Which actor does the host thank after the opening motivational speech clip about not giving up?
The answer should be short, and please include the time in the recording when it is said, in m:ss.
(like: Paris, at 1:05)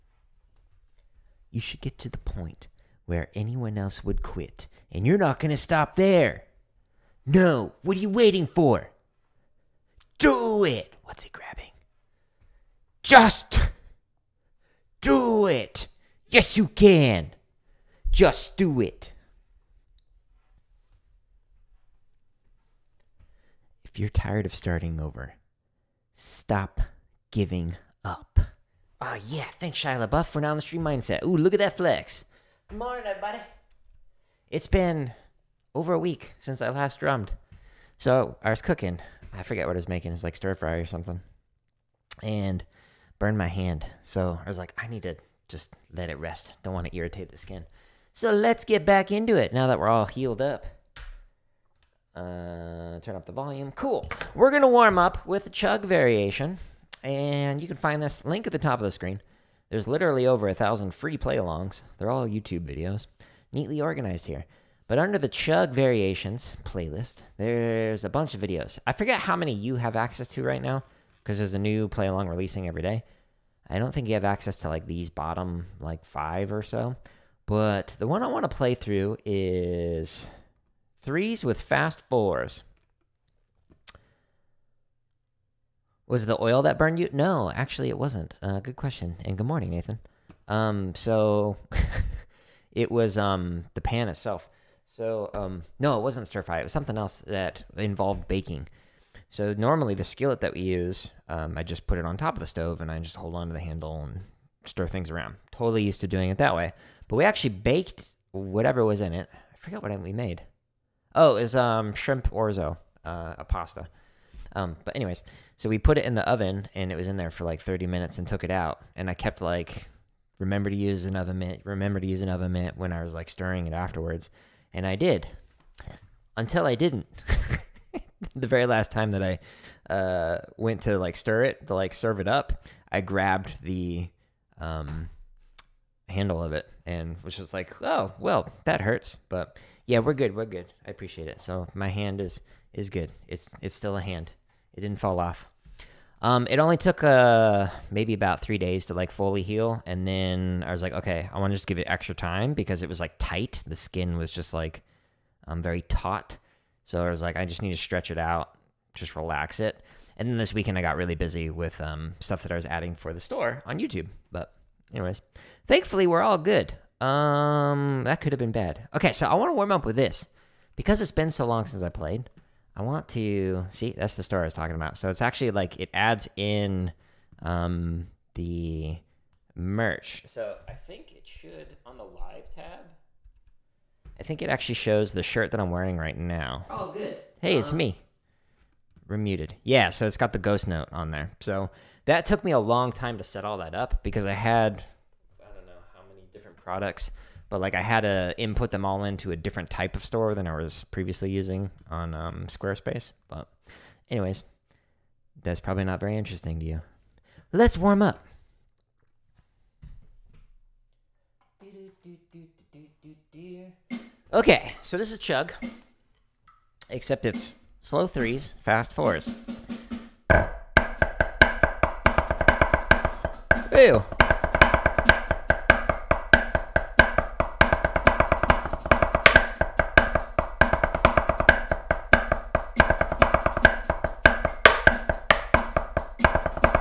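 Shia LaBeouf, at 0:29.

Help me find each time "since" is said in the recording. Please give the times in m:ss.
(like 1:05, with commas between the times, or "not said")
0:36, 2:51.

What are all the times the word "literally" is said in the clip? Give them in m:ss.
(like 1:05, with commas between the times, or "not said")
0:59.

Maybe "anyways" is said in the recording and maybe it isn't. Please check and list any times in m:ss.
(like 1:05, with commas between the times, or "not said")
1:54, 2:44, 3:24.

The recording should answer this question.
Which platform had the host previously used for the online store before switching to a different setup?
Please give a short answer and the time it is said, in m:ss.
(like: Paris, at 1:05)
Squarespace, at 3:22.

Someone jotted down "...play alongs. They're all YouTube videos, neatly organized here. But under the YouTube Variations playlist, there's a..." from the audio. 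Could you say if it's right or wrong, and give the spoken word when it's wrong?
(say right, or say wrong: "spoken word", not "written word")
wrong: "Chug", not "YouTube".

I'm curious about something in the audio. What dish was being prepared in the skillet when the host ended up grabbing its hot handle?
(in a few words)
shrimp orzo.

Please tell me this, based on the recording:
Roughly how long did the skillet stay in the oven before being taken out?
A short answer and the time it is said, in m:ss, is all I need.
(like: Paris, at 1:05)
30 minutes, at 1:57.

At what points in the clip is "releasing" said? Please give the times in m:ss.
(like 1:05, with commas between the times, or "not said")
1:12.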